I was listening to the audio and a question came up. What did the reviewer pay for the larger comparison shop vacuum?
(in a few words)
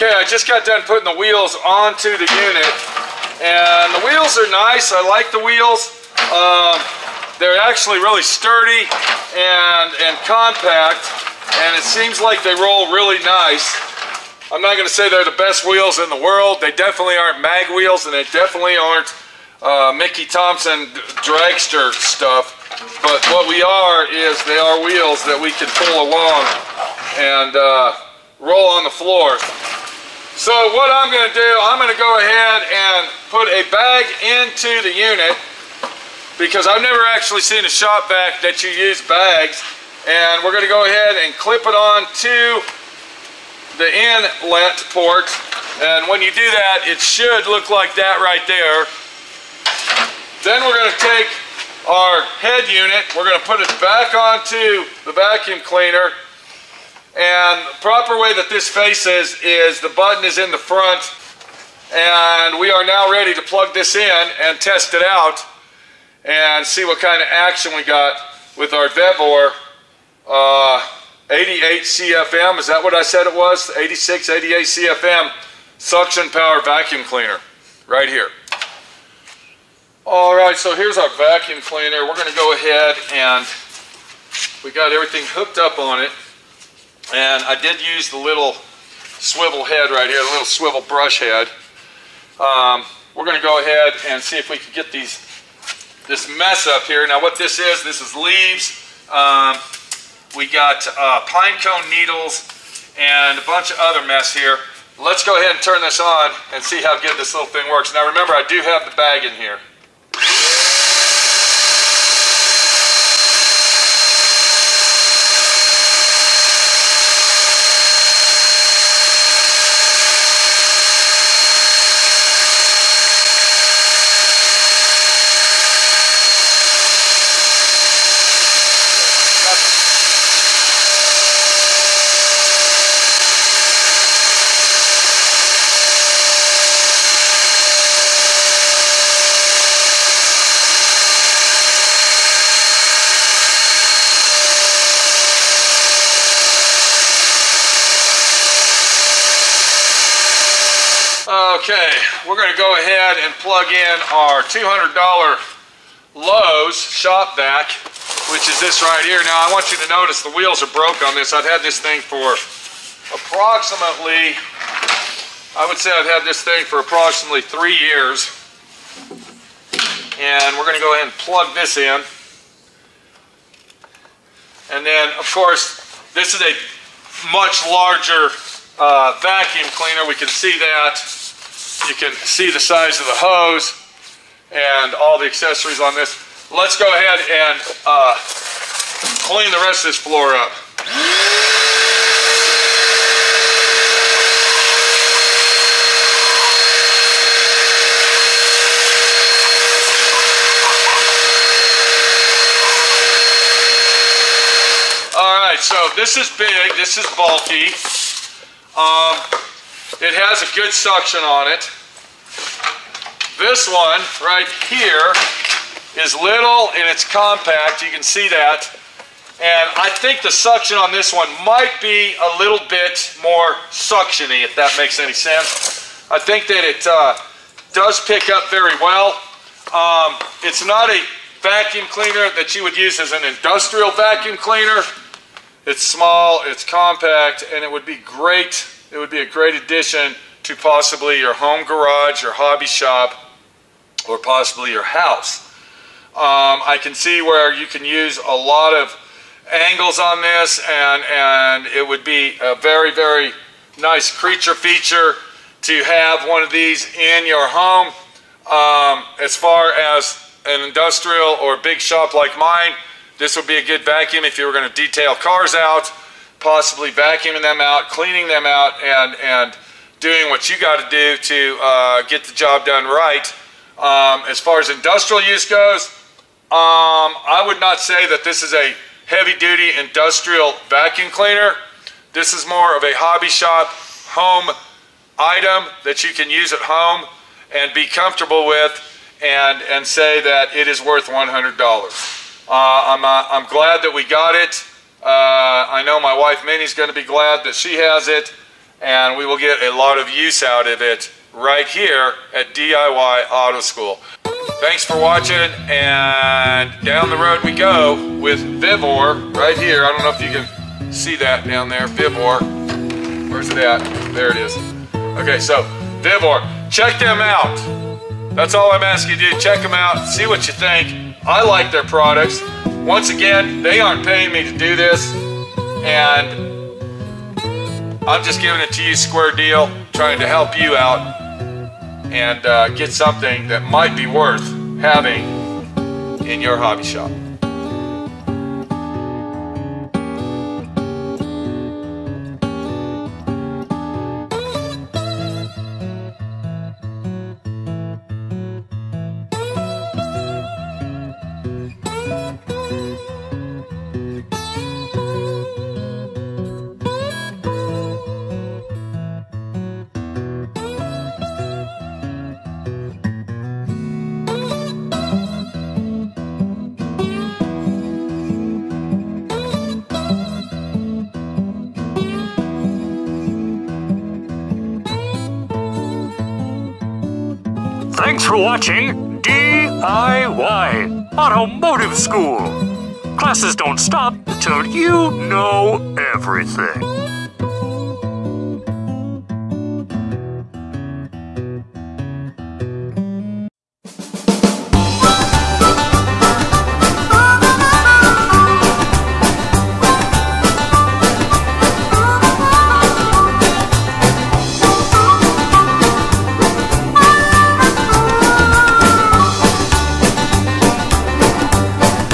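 $200.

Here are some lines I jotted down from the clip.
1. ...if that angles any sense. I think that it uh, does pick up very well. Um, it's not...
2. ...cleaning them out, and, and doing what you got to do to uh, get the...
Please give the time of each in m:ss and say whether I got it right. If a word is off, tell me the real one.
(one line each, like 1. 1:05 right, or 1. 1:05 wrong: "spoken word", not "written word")
1. 3:44 wrong: "makes", not "angles"
2. 4:27 right.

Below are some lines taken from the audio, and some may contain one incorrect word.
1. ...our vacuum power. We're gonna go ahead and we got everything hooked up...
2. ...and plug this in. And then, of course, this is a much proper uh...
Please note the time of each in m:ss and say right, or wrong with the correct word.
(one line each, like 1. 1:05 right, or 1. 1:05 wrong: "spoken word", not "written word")
1. 1:20 wrong: "cleaner", not "power"
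2. 2:51 wrong: "larger", not "proper".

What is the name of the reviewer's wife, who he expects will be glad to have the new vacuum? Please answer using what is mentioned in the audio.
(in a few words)
Minnie.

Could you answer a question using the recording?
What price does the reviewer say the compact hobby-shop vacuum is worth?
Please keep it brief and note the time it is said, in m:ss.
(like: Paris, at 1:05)
$100, at 4:51.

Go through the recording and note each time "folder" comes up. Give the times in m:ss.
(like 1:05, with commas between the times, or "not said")
not said.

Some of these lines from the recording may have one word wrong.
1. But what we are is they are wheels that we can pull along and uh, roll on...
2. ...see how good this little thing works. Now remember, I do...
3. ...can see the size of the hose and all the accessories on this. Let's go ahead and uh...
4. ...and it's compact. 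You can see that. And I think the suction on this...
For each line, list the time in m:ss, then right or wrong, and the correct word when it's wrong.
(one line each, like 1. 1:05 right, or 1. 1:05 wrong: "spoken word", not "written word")
1. 0:23 right
2. 1:46 right
3. 3:01 right
4. 3:36 right.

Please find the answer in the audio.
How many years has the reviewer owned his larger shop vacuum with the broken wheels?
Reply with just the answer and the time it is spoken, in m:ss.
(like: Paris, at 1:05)
3, at 2:47.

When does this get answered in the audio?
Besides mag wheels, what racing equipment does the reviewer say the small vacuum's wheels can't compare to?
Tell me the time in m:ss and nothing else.
0:19.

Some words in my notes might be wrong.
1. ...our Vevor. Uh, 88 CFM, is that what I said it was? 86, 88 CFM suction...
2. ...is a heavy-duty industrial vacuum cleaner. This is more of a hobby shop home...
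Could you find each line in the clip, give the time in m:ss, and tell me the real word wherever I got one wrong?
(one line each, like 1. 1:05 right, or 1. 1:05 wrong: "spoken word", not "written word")
1. 1:08 right
2. 4:38 right.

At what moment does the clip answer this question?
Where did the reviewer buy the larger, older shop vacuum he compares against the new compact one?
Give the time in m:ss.
2:36.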